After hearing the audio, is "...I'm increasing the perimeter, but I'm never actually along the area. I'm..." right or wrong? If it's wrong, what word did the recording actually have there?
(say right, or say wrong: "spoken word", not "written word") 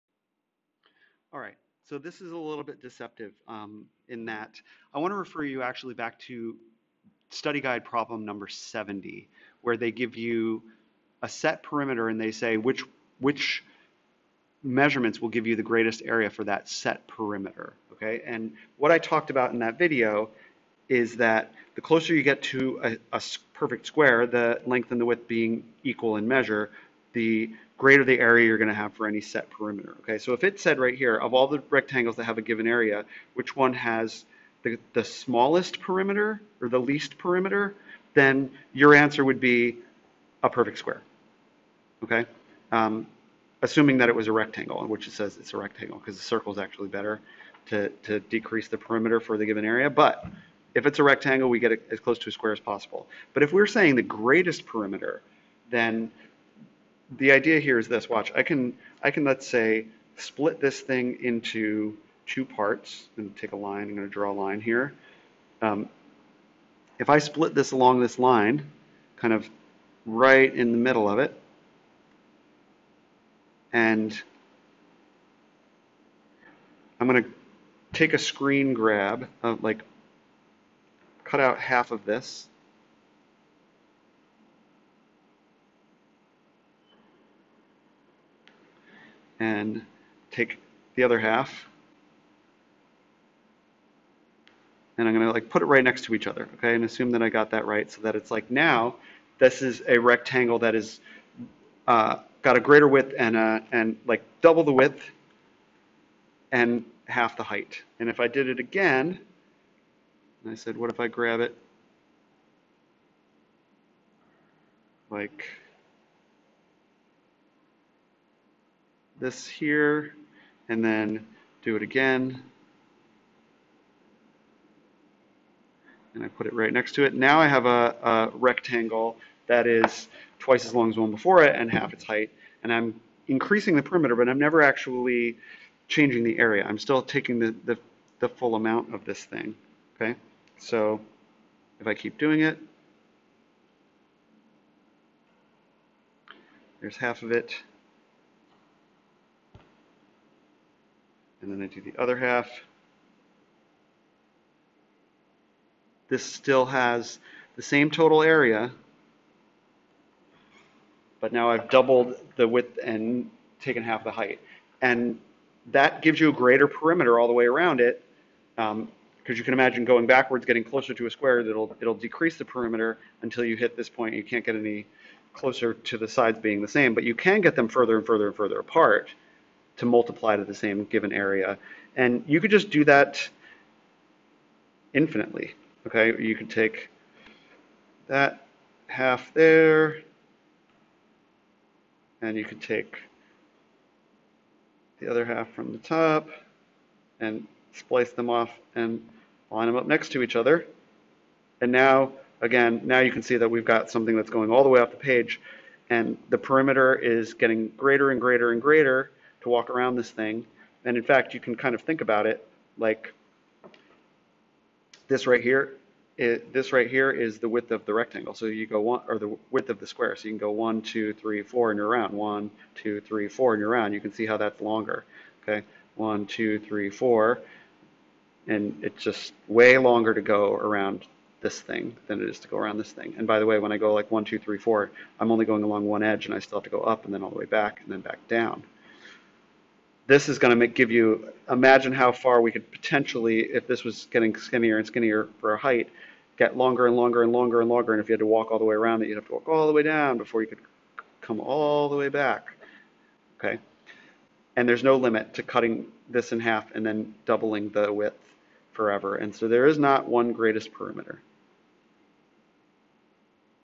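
wrong: "changing", not "along".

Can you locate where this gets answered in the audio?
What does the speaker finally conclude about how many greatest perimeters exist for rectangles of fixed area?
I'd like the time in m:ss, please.
4:19.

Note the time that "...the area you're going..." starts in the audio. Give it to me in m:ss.
0:28.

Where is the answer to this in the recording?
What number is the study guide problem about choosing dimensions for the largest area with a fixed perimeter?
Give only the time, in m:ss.
0:07.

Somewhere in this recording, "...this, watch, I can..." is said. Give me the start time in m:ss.
0:57.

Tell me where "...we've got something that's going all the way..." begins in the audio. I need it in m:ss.
3:23.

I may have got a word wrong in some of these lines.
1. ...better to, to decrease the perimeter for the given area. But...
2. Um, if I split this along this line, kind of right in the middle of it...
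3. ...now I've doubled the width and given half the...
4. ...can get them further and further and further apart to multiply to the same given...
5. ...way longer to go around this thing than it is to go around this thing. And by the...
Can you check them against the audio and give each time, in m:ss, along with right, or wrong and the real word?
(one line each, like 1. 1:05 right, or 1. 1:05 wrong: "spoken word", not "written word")
1. 0:46 right
2. 1:05 right
3. 2:41 wrong: "taken", not "given"
4. 2:57 right
5. 3:49 right.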